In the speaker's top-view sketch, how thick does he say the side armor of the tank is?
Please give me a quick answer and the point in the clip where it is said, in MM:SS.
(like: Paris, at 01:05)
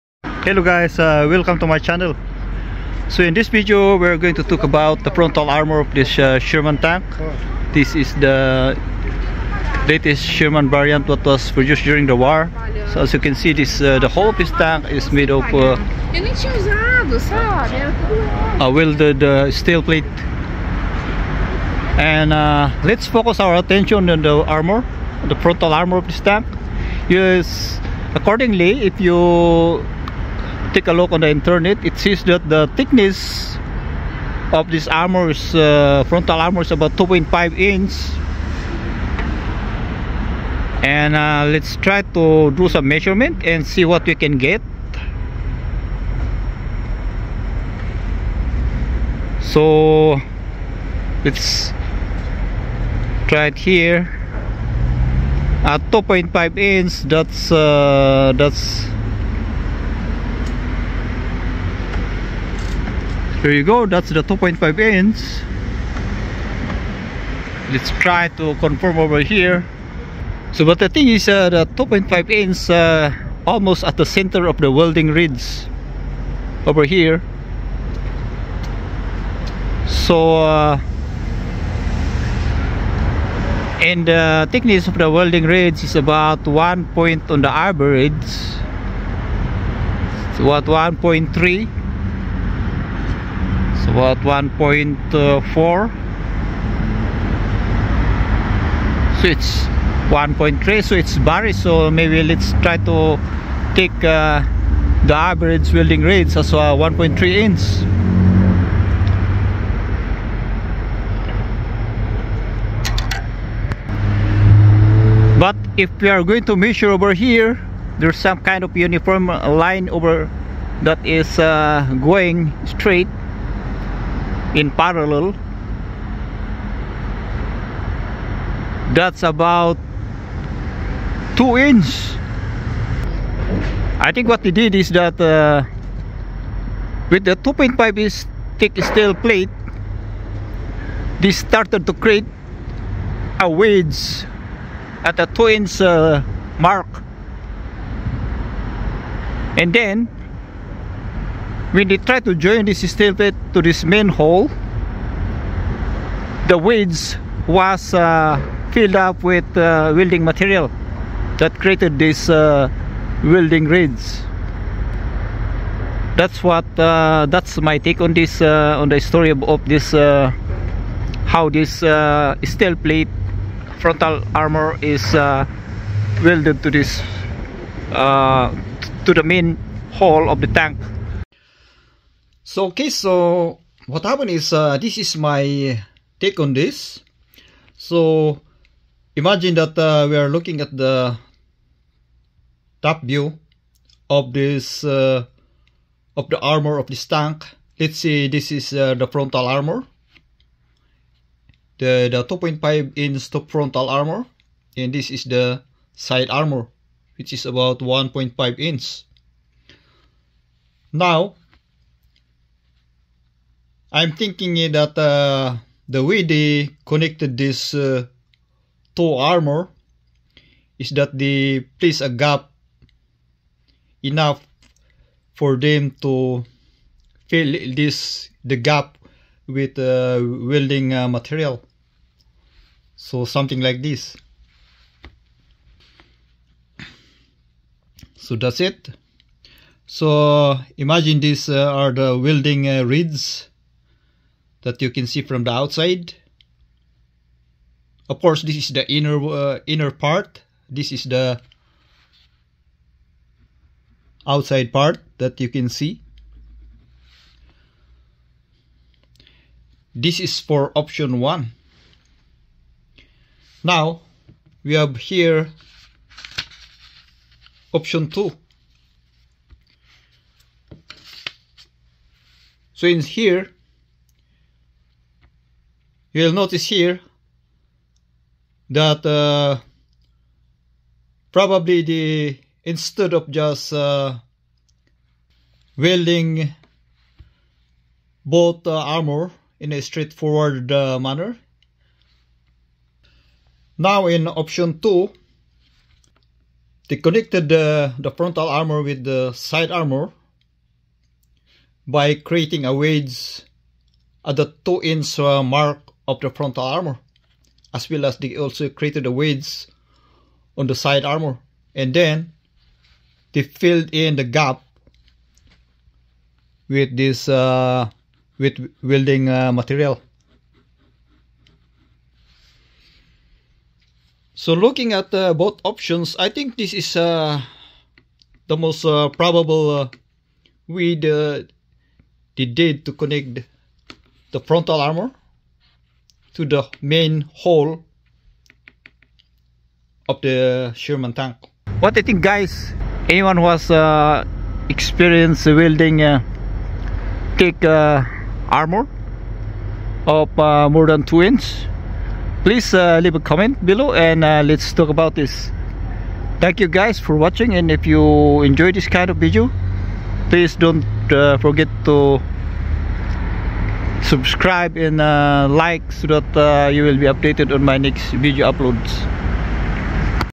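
1.5 inch, at 03:27.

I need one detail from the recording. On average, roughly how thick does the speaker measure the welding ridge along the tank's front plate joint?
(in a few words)
1.3 inch.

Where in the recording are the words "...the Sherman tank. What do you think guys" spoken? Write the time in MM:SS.
05:40.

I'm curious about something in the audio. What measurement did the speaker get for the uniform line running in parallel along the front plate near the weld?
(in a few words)
2 inch.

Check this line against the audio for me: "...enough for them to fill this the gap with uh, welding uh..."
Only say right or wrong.
right.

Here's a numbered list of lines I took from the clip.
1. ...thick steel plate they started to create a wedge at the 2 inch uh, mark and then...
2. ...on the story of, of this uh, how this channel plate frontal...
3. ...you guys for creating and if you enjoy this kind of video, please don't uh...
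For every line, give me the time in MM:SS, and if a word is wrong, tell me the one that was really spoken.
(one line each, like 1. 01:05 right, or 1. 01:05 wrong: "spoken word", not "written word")
1. 02:18 right
2. 02:48 wrong: "steel", not "channel"
3. 05:56 wrong: "watching", not "creating".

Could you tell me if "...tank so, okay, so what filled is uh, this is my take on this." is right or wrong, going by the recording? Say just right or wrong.
wrong.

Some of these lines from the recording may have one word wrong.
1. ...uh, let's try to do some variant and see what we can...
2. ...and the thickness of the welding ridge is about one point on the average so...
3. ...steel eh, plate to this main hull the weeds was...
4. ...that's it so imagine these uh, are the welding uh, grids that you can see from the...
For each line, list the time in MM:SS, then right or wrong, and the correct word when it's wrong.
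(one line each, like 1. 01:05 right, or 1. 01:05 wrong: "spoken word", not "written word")
1. 00:41 wrong: "measurement", not "variant"
2. 01:23 right
3. 02:32 right
4. 03:58 wrong: "reeds", not "grids".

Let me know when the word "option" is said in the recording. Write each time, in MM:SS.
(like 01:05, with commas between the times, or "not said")
04:20, 04:27, 04:54, 05:25.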